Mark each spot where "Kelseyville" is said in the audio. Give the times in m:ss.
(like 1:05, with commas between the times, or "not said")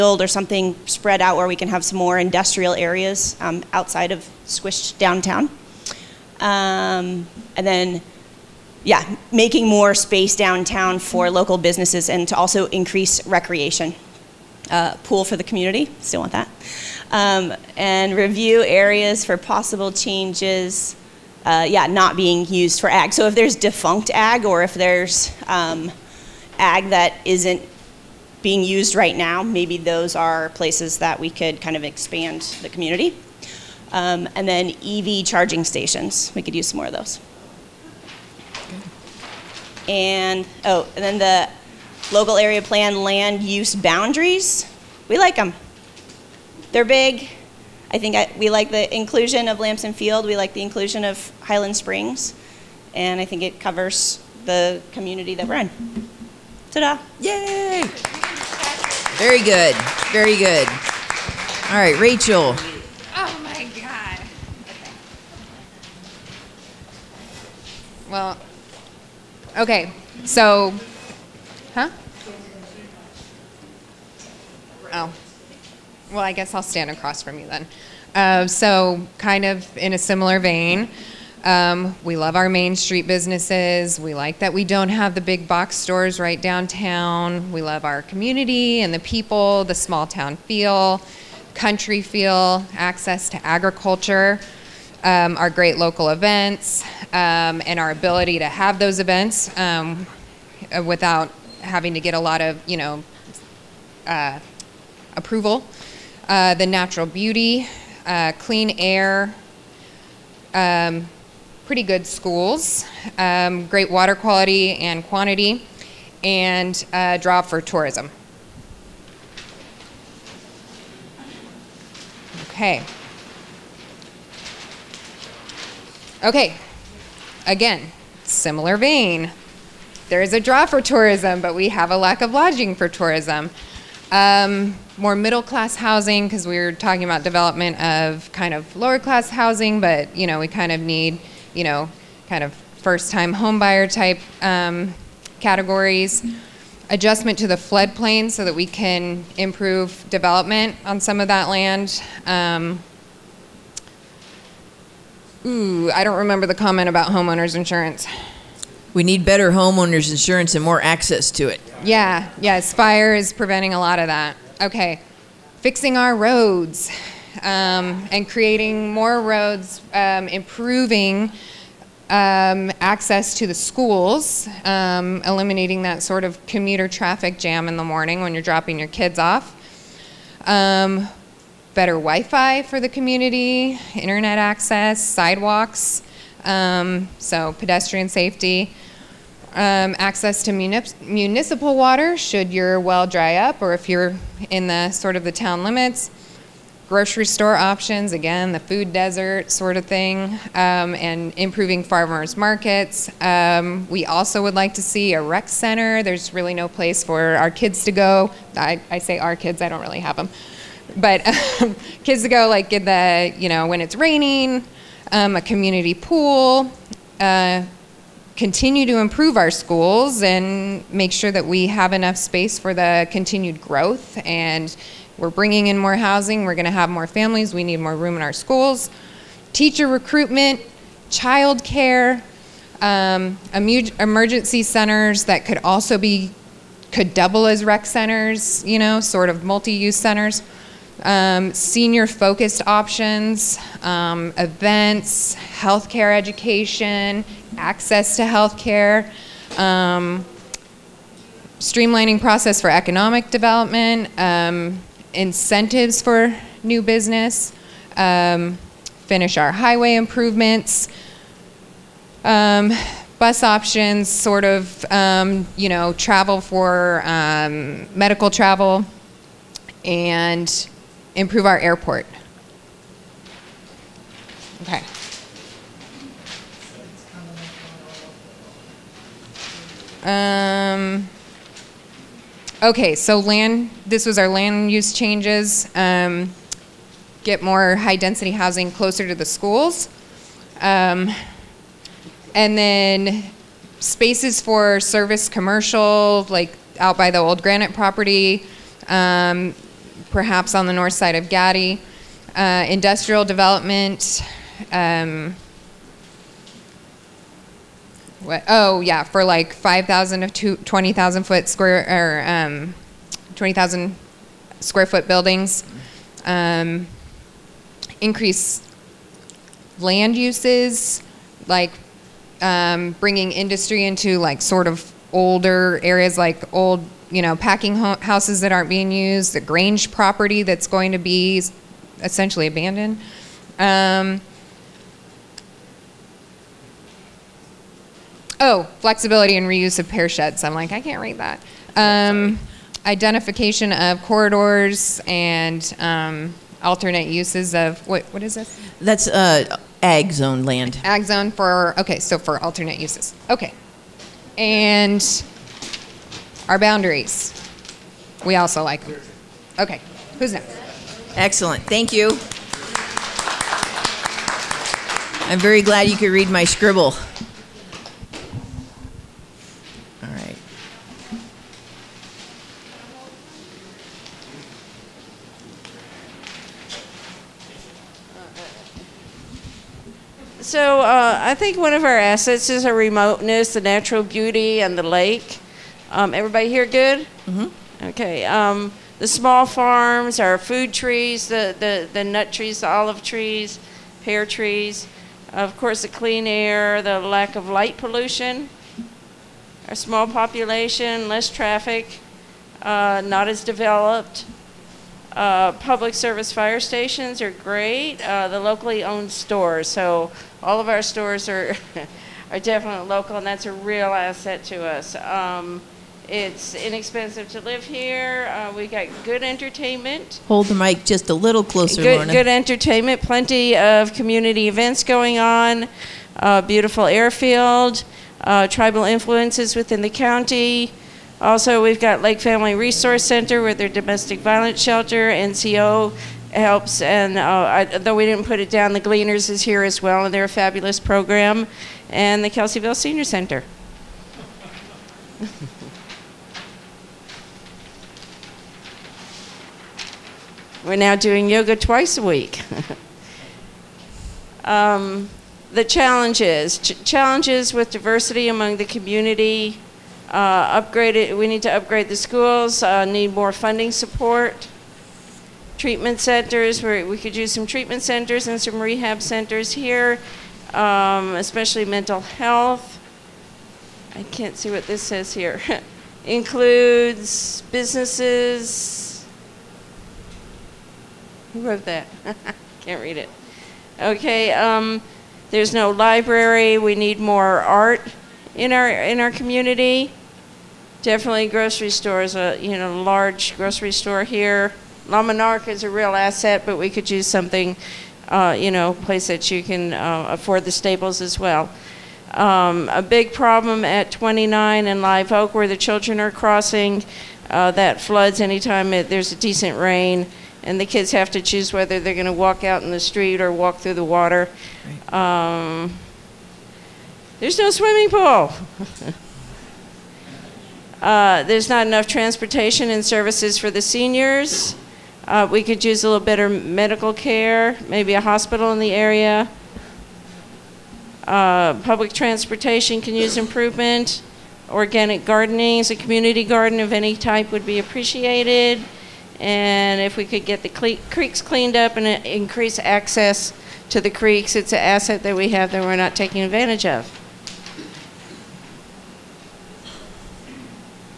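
7:22.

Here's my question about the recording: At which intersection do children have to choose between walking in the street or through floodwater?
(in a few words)
29 and Live Oak.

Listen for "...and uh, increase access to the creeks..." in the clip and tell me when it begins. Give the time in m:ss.
9:01.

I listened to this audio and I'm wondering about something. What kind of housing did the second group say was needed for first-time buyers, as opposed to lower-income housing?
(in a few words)
Middle class housing.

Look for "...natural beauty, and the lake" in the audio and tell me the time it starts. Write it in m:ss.
6:23.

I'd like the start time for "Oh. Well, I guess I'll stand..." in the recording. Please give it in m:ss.
1:14.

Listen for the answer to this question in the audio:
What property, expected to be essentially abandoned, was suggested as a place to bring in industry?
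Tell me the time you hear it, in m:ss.
5:29.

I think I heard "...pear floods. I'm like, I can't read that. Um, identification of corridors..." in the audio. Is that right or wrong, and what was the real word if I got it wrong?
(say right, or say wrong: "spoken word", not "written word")
wrong: "sheds", not "floods".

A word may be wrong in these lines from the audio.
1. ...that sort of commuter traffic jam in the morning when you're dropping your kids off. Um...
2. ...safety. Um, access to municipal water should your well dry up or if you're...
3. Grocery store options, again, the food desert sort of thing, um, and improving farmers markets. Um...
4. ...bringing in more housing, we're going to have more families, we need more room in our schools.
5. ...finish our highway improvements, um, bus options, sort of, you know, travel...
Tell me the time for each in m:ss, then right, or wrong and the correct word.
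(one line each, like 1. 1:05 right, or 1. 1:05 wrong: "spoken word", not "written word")
1. 2:55 right
2. 3:08 right
3. 3:16 right
4. 3:45 right
5. 4:19 right.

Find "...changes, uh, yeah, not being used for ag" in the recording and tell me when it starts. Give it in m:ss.
0:19.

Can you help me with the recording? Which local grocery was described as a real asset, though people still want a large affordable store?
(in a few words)
La Monarca.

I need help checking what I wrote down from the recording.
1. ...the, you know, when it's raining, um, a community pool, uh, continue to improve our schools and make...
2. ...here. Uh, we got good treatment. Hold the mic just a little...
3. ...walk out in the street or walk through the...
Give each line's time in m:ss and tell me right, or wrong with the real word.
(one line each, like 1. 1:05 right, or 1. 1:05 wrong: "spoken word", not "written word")
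1. 3:32 right
2. 6:57 wrong: "entertainment", not "treatment"
3. 8:32 right.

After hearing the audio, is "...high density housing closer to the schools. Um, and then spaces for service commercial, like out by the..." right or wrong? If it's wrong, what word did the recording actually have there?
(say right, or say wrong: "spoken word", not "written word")
right.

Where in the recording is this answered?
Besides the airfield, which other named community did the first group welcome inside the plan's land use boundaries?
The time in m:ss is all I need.
0:51.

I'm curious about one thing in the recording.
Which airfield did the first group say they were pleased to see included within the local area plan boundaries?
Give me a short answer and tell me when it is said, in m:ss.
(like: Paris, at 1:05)
Lampson Field, at 0:49.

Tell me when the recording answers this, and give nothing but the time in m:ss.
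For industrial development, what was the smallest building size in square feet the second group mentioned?
5:09.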